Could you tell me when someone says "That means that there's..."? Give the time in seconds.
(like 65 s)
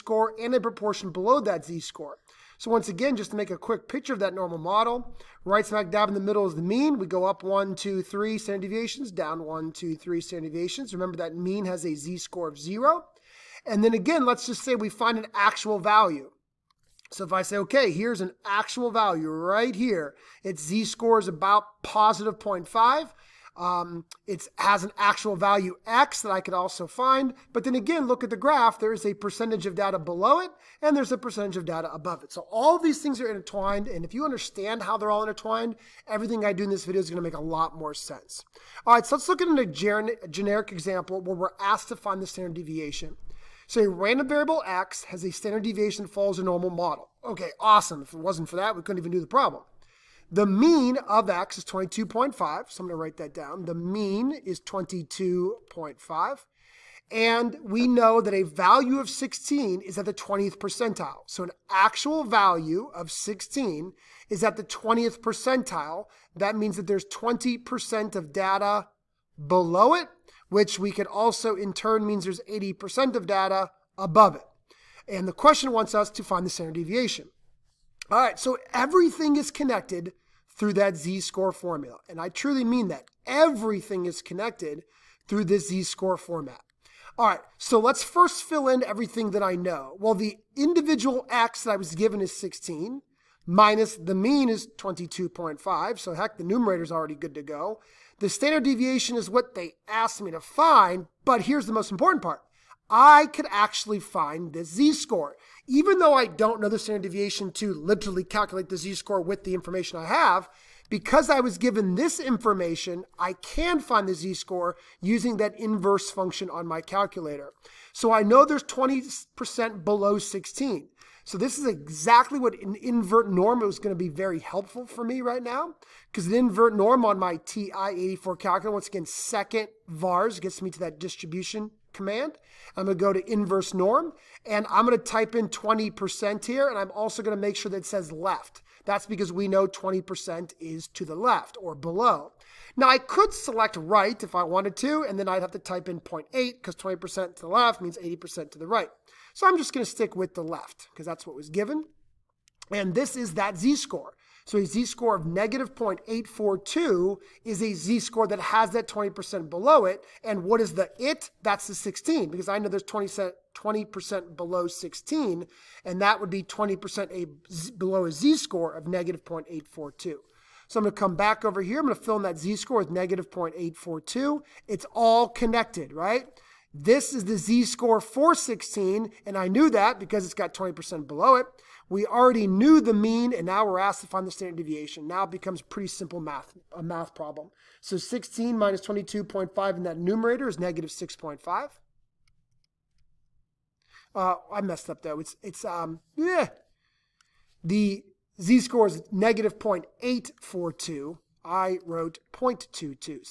66 s.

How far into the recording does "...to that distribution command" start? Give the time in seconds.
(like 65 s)
130 s.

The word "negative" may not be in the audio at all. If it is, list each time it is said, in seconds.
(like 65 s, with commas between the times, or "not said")
155 s, 168 s, 172 s, 190 s, 199 s.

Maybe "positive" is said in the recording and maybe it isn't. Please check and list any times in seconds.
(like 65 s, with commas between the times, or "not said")
21 s.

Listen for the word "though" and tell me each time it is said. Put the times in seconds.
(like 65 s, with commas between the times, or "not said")
105 s, 195 s.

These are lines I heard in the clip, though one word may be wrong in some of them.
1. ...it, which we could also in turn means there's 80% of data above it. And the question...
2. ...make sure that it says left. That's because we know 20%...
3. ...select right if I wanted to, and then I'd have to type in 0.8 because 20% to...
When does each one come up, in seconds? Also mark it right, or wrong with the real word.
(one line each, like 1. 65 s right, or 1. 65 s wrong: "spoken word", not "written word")
1. 69 s right
2. 137 s right
3. 143 s right.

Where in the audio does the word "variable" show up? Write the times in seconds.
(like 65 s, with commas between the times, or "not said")
44 s.